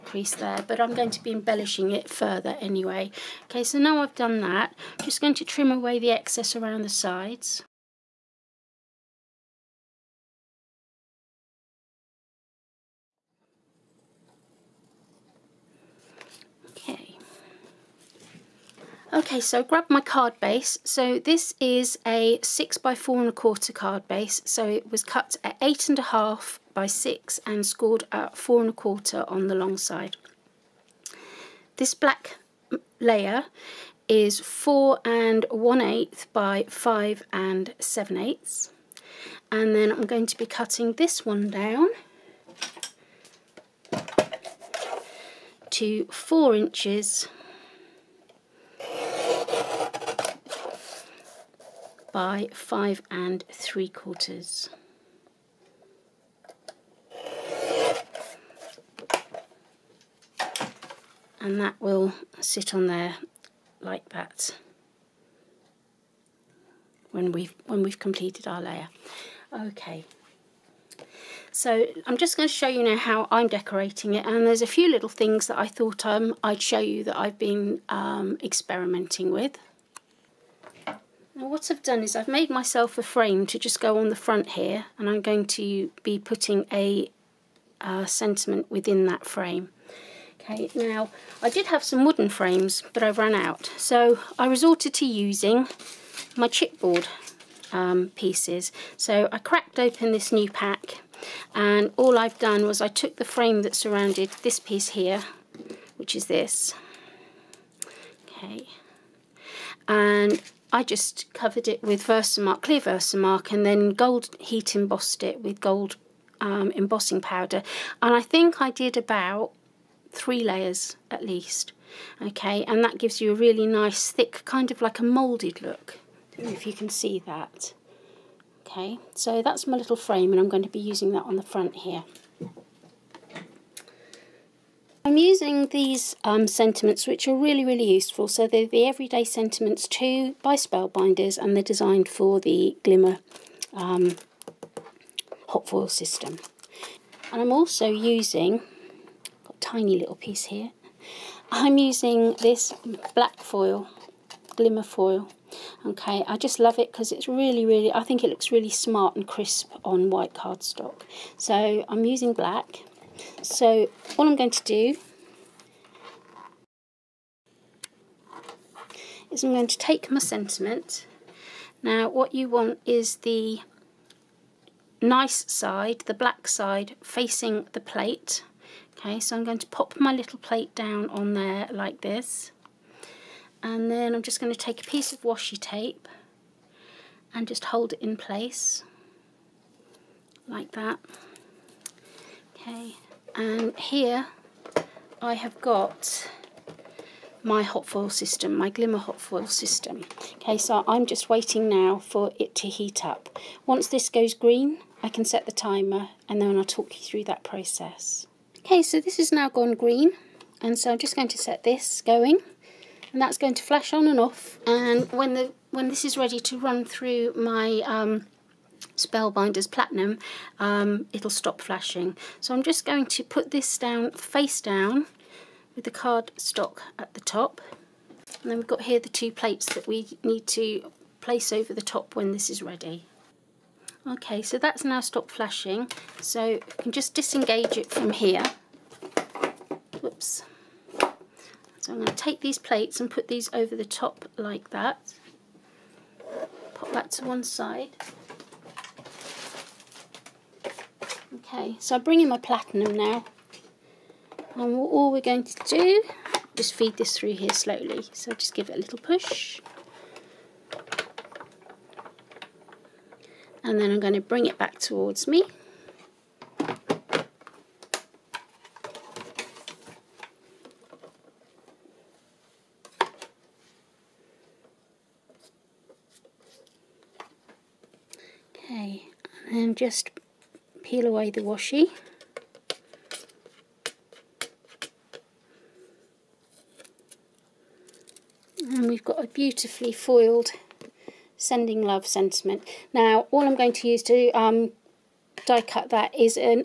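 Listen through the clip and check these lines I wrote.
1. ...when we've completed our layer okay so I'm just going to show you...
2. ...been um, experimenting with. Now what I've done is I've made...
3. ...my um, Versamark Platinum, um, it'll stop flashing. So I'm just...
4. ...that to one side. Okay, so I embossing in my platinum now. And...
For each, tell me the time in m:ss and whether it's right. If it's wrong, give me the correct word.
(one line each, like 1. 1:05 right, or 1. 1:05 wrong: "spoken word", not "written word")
1. 1:07 right
2. 1:17 right
3. 3:37 wrong: "Spellbinders", not "Versamark"
4. 4:06 wrong: "bring", not "embossing".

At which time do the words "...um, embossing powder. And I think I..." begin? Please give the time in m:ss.
1:56.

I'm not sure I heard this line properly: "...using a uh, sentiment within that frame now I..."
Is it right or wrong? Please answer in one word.
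wrong.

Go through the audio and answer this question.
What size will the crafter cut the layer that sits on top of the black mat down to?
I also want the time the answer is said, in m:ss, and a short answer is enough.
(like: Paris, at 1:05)
4 by 5 3/4 inches, at 0:46.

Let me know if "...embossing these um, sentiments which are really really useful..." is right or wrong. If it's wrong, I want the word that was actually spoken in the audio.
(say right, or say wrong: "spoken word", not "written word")
wrong: "using", not "embossing".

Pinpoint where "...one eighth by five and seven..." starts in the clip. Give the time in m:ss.
0:35.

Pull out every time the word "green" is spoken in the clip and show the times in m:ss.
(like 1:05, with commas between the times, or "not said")
3:24, 3:29.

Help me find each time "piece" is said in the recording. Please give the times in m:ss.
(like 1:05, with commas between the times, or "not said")
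1:38, 1:44, 2:30, 3:04.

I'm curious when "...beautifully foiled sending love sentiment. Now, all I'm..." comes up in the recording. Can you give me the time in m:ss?
4:49.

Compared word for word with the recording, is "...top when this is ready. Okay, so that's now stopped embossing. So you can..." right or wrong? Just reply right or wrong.
wrong.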